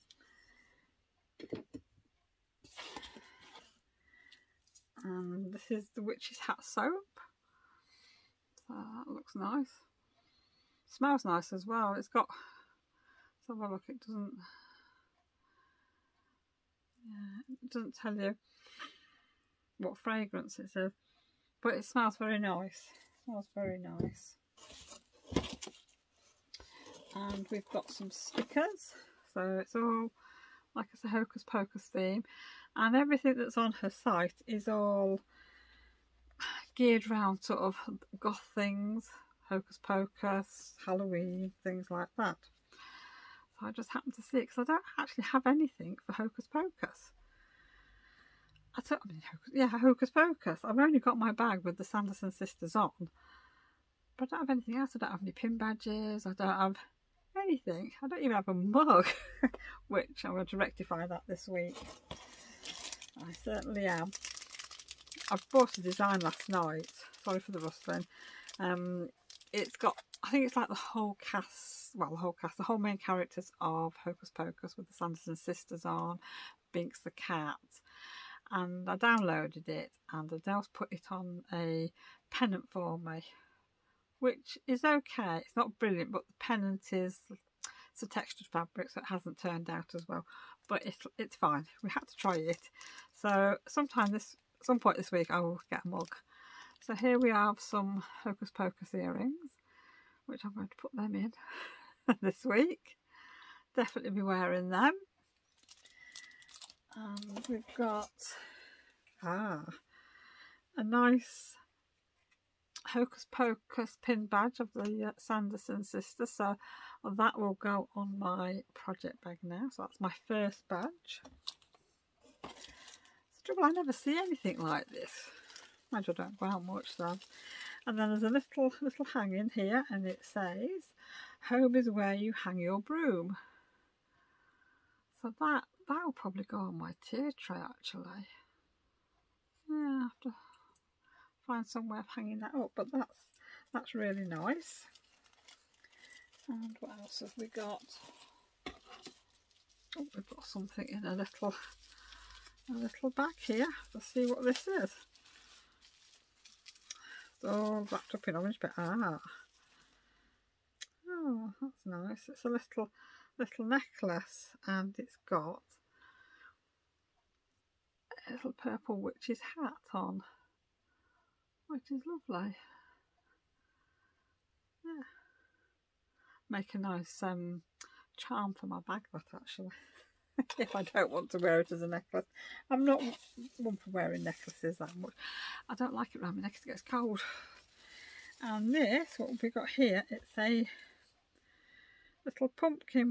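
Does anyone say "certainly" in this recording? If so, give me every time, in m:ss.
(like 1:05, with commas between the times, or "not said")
1:03.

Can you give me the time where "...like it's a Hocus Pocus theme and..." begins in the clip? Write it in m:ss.
0:30.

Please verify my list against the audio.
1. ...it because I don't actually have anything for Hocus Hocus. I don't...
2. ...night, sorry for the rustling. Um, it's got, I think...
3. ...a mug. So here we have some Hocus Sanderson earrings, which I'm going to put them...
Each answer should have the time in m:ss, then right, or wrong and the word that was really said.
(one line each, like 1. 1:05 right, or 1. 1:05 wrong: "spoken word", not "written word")
1. 0:44 wrong: "Pocus", not "Hocus"
2. 1:06 right
3. 1:35 wrong: "Pocus", not "Sanderson".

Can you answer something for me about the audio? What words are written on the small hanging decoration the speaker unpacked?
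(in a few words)
Home is where you hang your broom.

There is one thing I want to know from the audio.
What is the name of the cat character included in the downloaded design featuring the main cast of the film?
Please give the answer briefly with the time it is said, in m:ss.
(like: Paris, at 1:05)
Binks, at 1:16.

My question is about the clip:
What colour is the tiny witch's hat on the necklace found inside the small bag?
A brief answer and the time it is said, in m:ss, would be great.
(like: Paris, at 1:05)
Purple, at 2:48.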